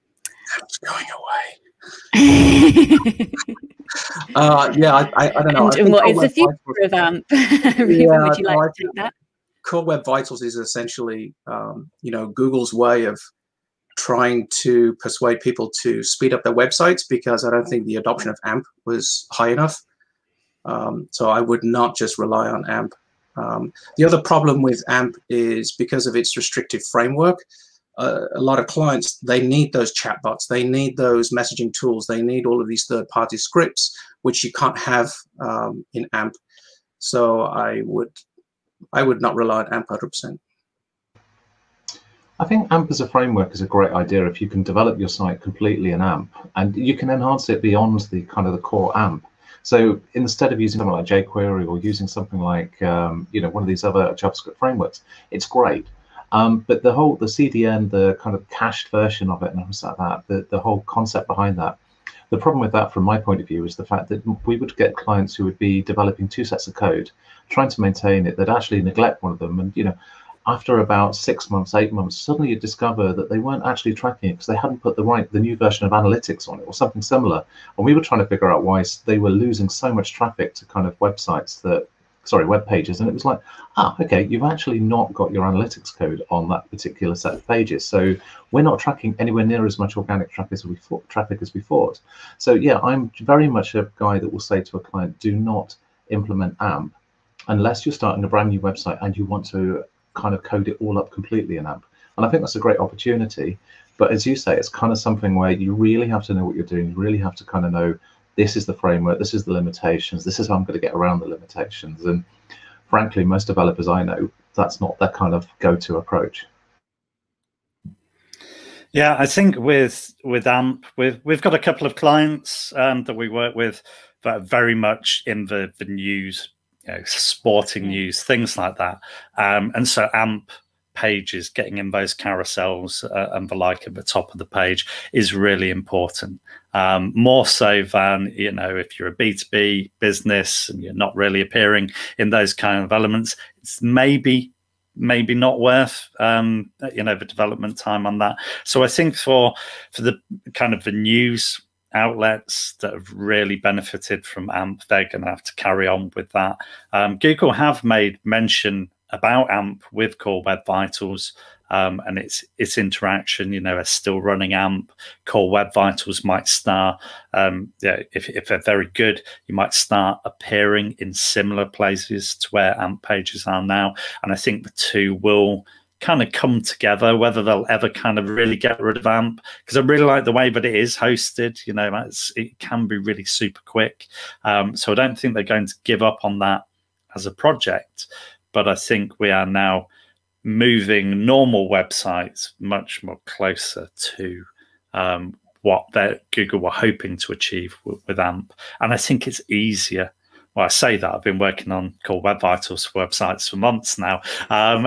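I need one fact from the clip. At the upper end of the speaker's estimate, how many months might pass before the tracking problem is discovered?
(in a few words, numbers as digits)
8 months.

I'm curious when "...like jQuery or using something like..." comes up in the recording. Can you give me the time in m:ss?
0:50.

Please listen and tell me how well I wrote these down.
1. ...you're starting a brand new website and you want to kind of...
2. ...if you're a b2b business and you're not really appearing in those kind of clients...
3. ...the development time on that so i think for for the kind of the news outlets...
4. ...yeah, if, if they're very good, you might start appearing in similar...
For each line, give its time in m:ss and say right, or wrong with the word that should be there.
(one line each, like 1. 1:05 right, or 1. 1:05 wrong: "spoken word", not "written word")
1. 1:37 right
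2. 2:18 wrong: "elements", not "clients"
3. 2:27 right
4. 2:47 right.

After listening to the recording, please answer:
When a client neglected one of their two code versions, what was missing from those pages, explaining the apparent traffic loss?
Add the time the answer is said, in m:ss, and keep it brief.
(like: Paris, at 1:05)
analytics code, at 1:25.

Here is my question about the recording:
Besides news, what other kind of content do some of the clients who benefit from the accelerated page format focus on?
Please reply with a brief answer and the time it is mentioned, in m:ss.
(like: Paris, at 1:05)
sporting, at 2:07.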